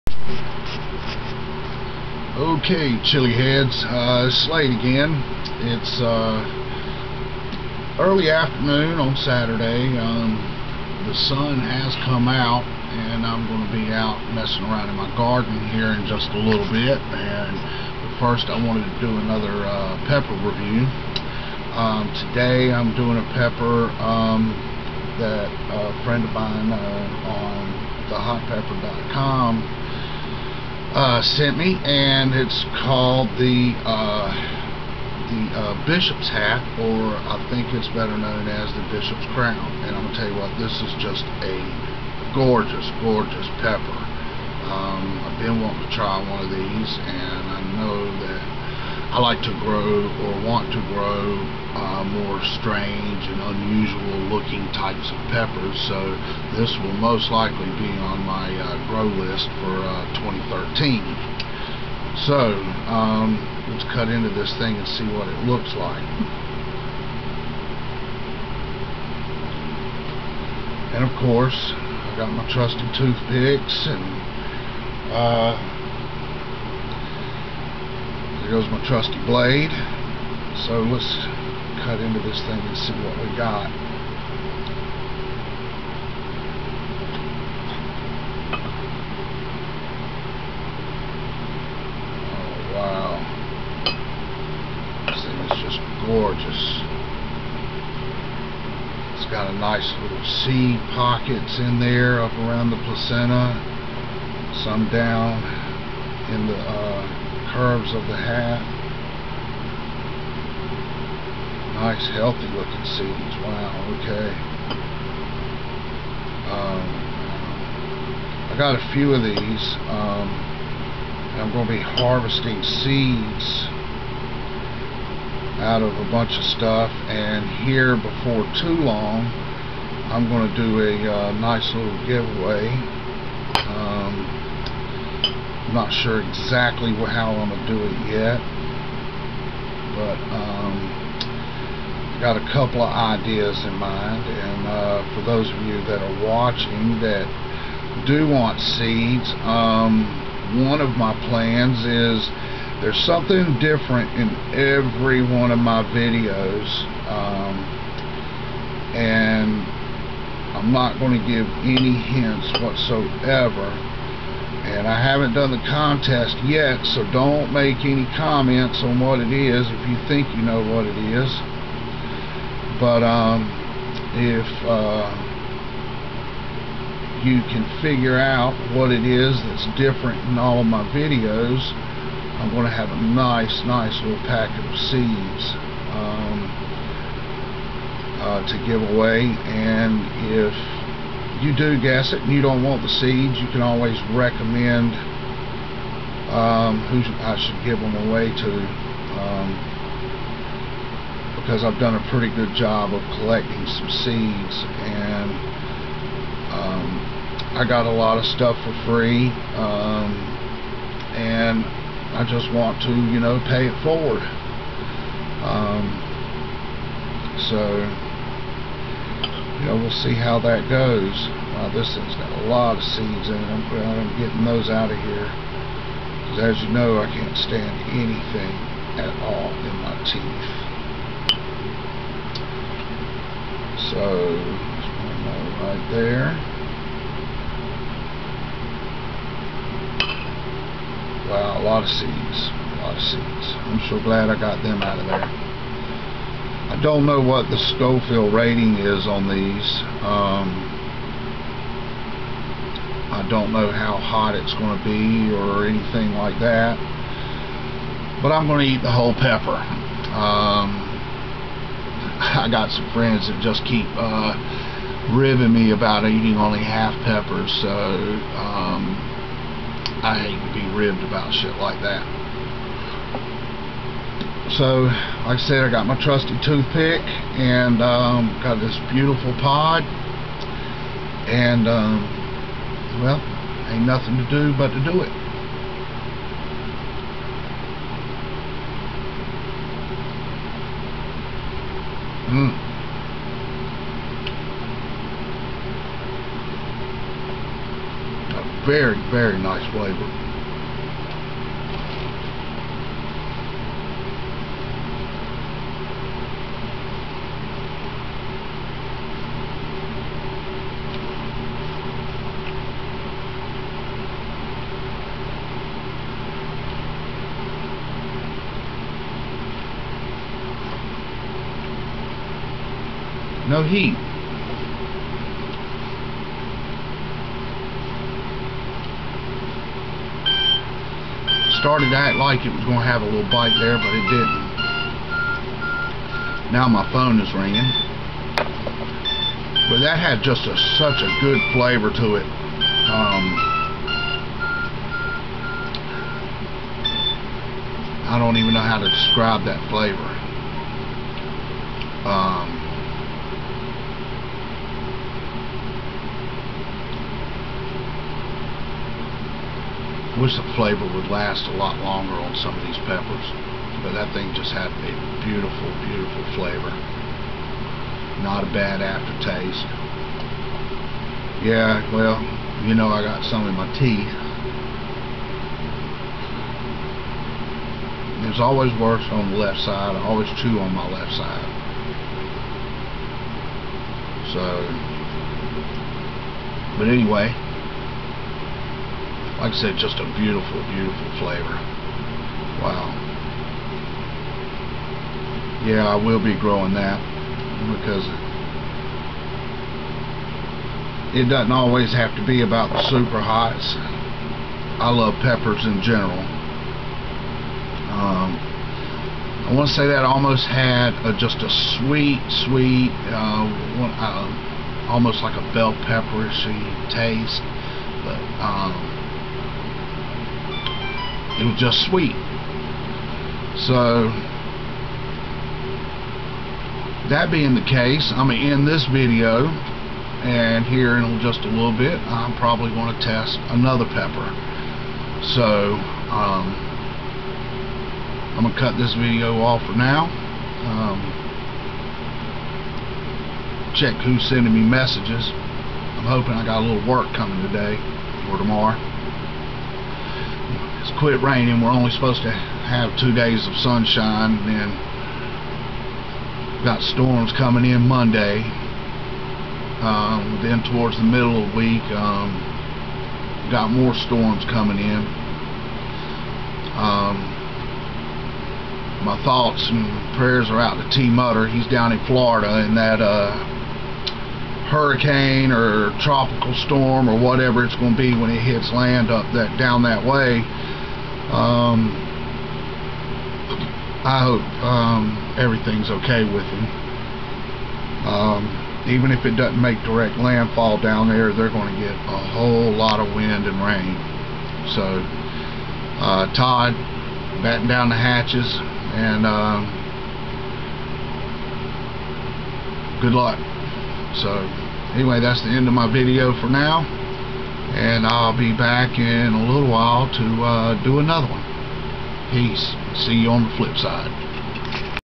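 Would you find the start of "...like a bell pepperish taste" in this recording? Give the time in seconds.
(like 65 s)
415 s.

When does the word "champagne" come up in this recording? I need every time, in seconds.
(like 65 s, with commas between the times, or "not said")
not said.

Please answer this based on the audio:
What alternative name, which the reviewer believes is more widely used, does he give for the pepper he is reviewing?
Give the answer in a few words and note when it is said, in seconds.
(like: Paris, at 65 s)
Bishop's Crown, at 38 s.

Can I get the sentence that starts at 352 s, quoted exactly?
Uh, wish the flavor would last a lot longer on some of these peppers.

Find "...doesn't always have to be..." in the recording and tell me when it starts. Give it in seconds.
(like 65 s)
401 s.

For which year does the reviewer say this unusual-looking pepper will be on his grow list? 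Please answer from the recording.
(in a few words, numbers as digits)
2013.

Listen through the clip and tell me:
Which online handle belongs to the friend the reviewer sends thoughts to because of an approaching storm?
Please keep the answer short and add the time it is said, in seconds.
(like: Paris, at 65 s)
Tmudder, at 470 s.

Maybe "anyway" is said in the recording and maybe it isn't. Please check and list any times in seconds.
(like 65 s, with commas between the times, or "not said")
386 s, 504 s.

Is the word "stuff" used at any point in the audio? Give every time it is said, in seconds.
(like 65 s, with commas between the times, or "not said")
126 s, 208 s.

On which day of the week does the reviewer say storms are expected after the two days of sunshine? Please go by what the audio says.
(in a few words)
Monday.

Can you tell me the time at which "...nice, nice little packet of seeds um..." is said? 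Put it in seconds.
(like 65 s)
183 s.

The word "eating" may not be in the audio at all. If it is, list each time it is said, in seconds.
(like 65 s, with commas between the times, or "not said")
266 s.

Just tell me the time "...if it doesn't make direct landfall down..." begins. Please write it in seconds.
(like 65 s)
489 s.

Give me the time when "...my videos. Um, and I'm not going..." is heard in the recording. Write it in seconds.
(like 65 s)
155 s.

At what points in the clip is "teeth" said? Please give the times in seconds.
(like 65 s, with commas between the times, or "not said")
230 s, 373 s.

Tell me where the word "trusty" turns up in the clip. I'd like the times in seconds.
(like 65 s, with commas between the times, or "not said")
72 s, 78 s, 276 s.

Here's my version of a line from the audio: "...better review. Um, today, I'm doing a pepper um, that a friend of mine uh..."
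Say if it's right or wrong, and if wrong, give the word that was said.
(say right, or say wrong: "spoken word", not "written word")
wrong: "pepper", not "better".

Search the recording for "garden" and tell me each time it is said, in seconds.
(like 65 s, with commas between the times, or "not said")
15 s.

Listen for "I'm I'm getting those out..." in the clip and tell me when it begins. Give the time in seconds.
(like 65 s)
223 s.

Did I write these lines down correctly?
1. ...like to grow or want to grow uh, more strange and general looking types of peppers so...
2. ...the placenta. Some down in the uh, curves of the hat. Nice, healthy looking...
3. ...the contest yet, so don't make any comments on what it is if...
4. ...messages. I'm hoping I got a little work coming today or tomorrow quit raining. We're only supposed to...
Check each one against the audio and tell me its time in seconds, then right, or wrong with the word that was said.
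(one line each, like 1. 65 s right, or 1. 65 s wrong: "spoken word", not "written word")
1. 49 s wrong: "unusual", not "general"
2. 102 s right
3. 165 s right
4. 444 s right.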